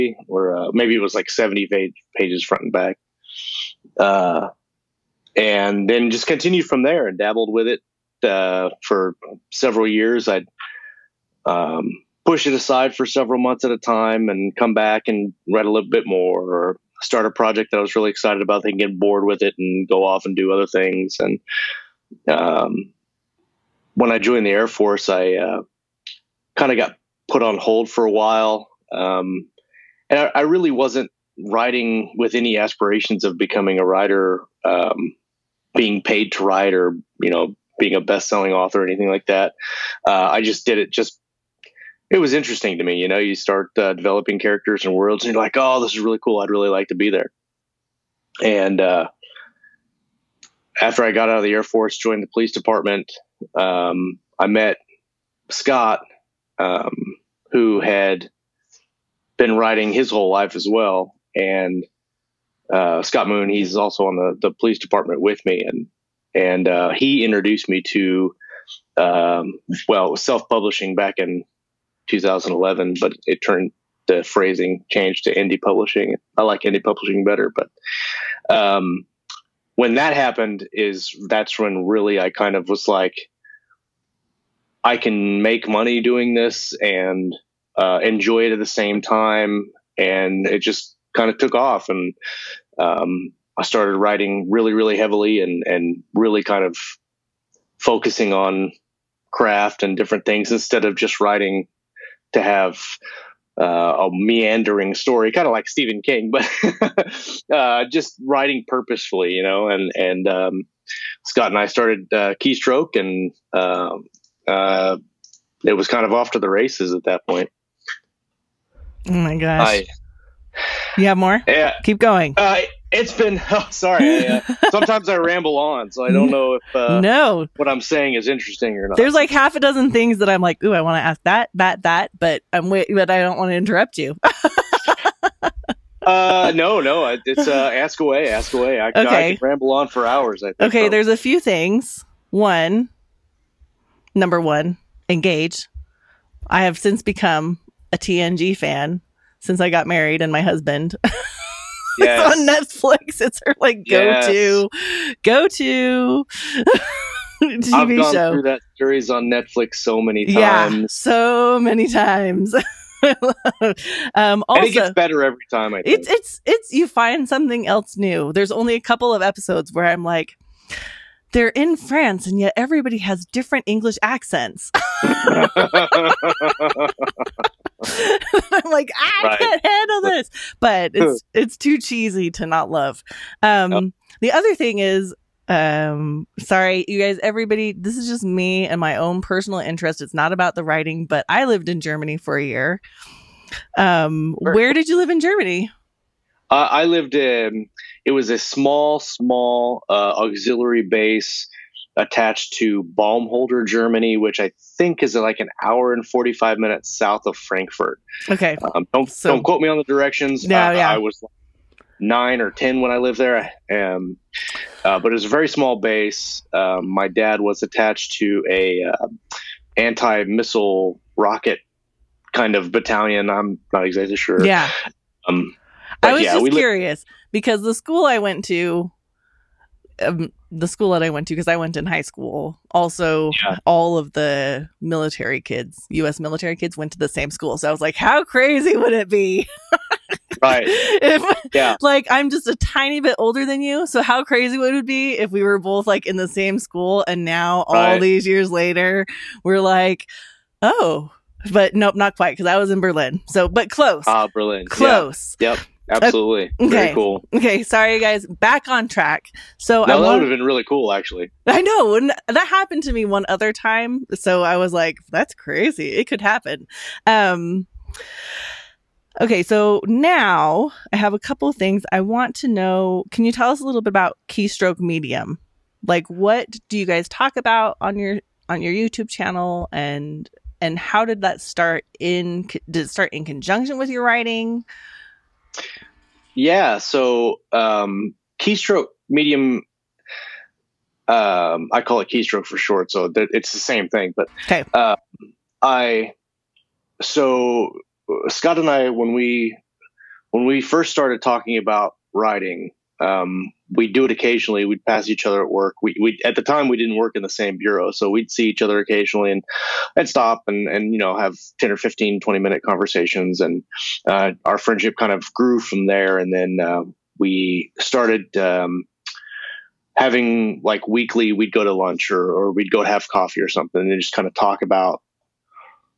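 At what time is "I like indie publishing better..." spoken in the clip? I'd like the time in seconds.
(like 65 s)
76 s.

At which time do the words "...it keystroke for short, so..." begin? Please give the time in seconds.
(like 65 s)
292 s.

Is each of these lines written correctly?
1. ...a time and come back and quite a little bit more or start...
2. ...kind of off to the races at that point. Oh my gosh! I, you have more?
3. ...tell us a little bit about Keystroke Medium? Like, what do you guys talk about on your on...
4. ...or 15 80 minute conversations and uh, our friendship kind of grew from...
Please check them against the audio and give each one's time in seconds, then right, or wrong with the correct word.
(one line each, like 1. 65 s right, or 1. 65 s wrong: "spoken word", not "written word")
1. 13 s wrong: "write", not "quite"
2. 115 s right
3. 273 s right
4. 311 s wrong: "20", not "80".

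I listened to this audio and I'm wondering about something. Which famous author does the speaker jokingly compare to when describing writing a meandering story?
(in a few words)
Stephen King.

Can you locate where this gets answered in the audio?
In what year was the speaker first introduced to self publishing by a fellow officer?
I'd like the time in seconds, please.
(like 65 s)
72 s.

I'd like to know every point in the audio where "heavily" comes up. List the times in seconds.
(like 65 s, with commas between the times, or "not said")
94 s.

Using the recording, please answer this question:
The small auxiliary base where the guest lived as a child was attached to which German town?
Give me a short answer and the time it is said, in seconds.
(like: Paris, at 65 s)
Baumholder, at 202 s.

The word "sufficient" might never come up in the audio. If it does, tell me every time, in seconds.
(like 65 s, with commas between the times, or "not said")
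not said.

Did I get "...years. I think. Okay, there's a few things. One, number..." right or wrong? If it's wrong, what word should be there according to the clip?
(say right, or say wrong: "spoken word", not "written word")
wrong: "hours", not "years".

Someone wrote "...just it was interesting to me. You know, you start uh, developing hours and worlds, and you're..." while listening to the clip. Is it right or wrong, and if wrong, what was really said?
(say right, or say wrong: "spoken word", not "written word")
wrong: "characters", not "hours".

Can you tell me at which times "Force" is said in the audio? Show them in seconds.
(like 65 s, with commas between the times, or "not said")
24 s, 51 s.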